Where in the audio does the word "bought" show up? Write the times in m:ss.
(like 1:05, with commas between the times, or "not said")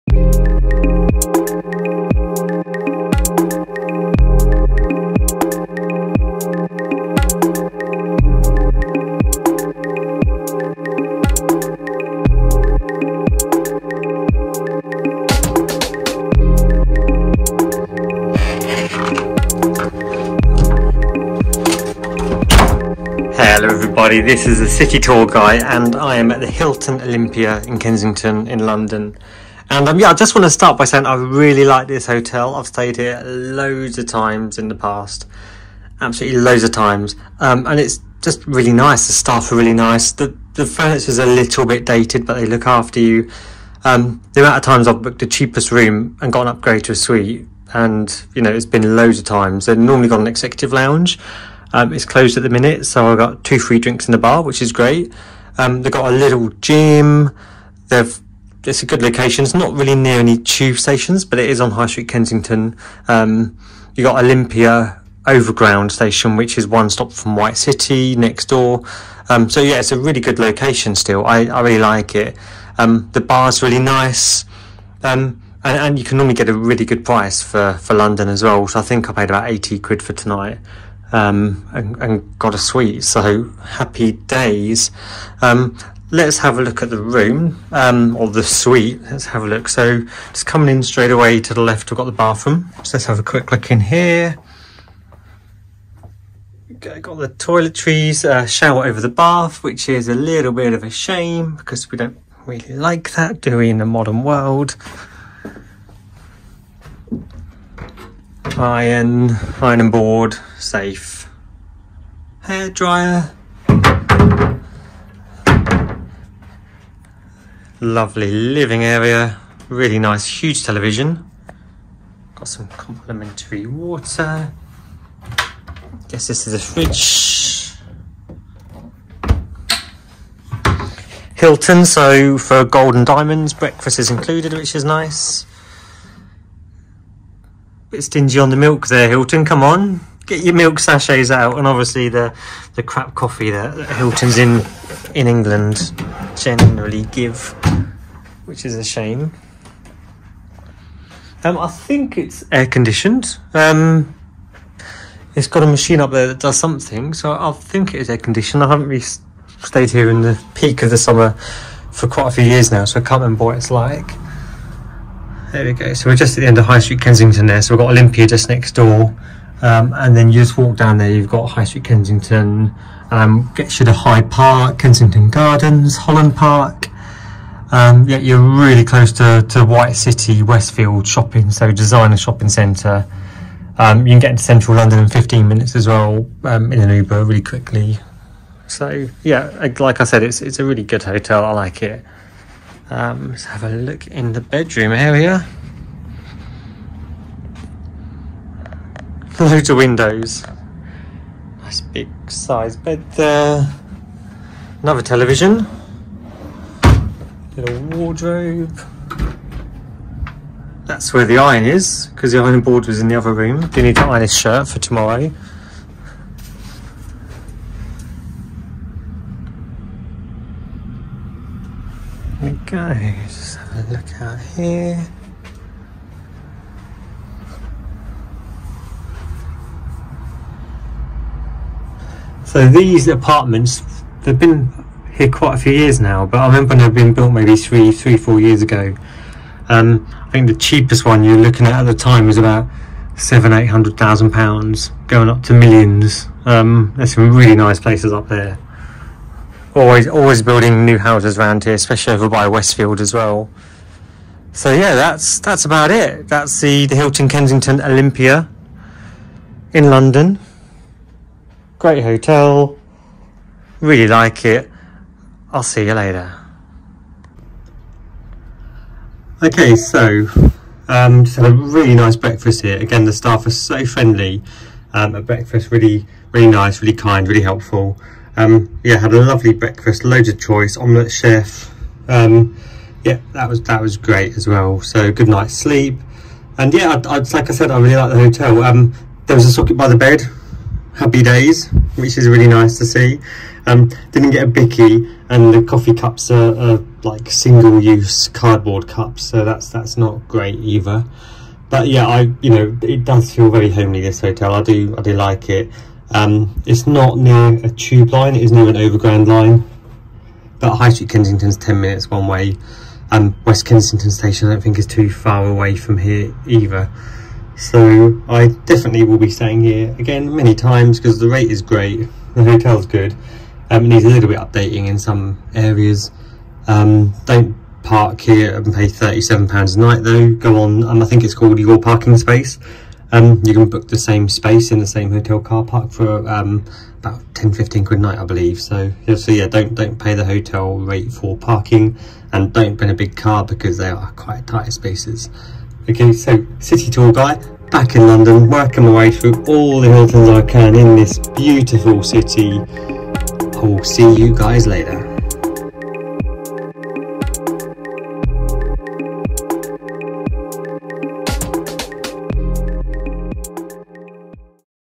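not said.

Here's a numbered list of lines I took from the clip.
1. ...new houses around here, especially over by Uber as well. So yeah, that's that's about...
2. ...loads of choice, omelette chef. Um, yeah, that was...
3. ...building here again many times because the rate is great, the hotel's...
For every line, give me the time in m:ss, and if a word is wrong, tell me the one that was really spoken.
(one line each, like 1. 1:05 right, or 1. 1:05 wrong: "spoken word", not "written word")
1. 4:10 wrong: "Westfield", not "Uber"
2. 4:40 right
3. 5:19 wrong: "staying", not "building".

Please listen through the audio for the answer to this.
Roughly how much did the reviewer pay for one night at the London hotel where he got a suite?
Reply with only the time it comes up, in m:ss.
1:19.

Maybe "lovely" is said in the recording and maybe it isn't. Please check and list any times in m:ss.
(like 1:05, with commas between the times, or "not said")
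1:57, 4:39.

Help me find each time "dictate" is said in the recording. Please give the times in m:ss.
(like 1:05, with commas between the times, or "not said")
not said.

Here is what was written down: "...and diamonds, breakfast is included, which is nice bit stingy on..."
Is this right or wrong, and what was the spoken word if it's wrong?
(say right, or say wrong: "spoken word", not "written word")
right.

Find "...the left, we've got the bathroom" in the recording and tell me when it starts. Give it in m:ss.
1:31.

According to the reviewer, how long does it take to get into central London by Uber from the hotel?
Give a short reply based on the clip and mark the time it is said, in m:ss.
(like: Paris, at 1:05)
15 minutes, at 3:05.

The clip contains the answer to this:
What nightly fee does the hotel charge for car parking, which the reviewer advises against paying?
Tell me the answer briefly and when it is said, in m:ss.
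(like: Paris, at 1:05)
£37, at 5:28.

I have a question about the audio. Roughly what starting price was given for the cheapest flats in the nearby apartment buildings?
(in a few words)
£700,000-£800,000.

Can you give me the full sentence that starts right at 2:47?
So we've got Olympia just next door.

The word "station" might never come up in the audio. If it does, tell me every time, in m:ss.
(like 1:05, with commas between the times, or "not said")
1:00, 1:05, 5:14.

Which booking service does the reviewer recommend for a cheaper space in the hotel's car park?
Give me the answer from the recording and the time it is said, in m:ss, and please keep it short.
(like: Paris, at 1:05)
Your Parking Space, at 5:31.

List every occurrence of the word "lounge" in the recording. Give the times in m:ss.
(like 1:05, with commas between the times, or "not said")
0:50.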